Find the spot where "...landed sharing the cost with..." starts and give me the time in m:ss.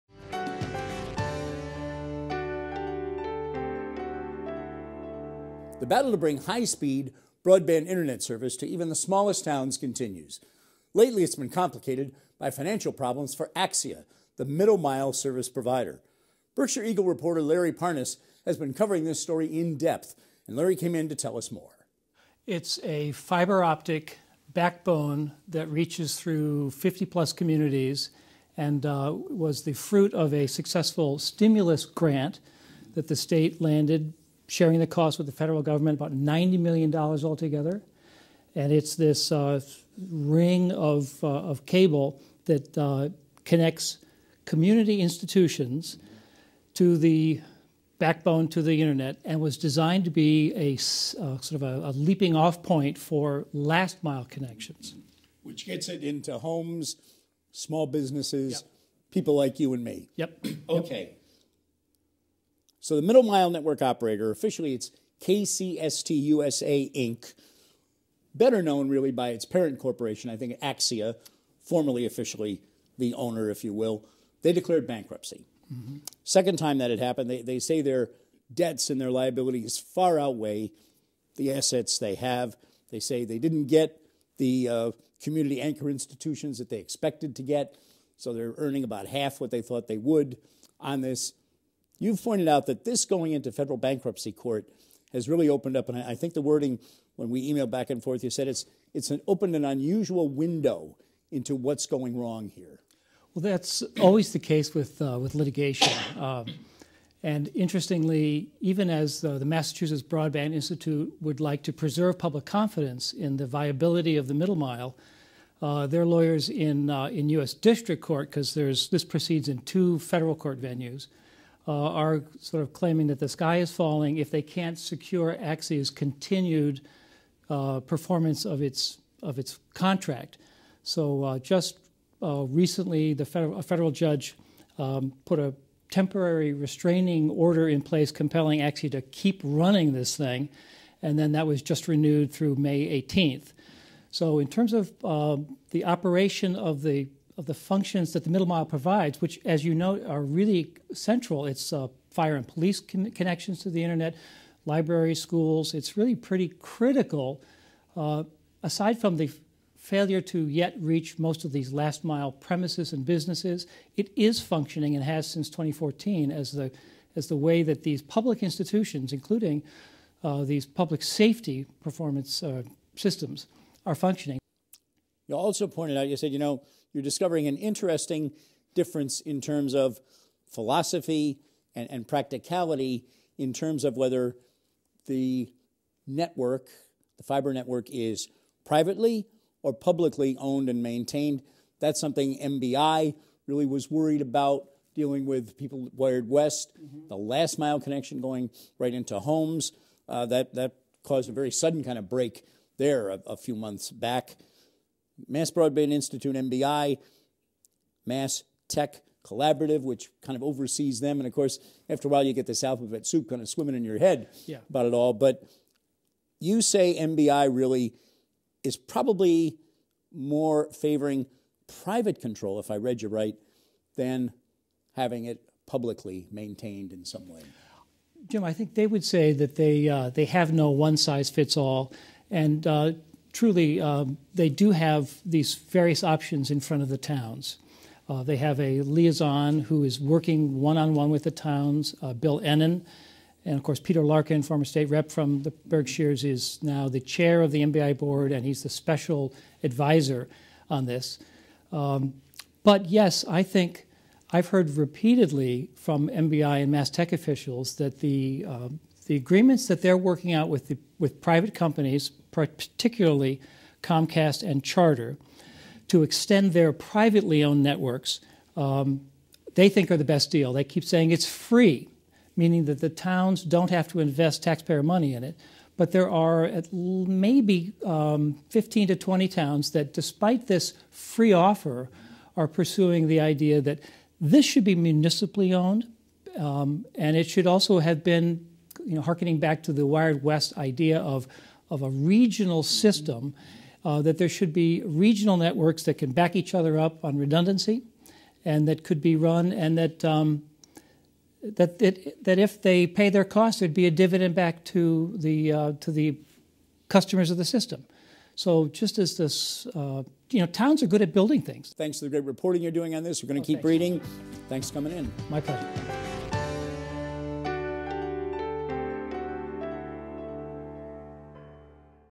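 0:33.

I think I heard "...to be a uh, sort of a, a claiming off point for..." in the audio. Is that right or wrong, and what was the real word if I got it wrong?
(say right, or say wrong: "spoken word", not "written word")
wrong: "leaping", not "claiming".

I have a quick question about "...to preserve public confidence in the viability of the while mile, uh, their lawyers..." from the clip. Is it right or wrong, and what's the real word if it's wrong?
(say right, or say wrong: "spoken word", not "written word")
wrong: "middle", not "while".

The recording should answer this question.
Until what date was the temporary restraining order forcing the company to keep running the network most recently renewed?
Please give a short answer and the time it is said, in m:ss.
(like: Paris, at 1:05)
May 18th, at 2:22.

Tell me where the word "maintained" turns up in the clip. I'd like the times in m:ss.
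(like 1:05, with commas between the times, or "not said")
3:10, 3:46.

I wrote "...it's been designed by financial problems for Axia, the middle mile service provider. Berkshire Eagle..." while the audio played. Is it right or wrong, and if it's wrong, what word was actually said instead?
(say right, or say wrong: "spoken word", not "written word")
wrong: "complicated", not "designed".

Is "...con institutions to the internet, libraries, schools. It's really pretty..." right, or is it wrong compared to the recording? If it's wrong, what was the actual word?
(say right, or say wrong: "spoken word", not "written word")
wrong: "connections", not "institutions".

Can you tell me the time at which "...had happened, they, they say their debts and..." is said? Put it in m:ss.
1:16.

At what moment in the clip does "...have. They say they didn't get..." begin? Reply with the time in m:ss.
1:22.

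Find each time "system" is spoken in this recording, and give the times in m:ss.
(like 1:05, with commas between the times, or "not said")
2:52, 4:52, 5:07.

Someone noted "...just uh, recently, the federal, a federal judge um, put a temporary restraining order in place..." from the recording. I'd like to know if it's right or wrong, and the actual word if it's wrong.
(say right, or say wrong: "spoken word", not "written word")
right.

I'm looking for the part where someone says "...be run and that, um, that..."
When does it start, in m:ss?
4:59.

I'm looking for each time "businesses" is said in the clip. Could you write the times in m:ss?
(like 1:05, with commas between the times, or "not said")
0:57, 2:43.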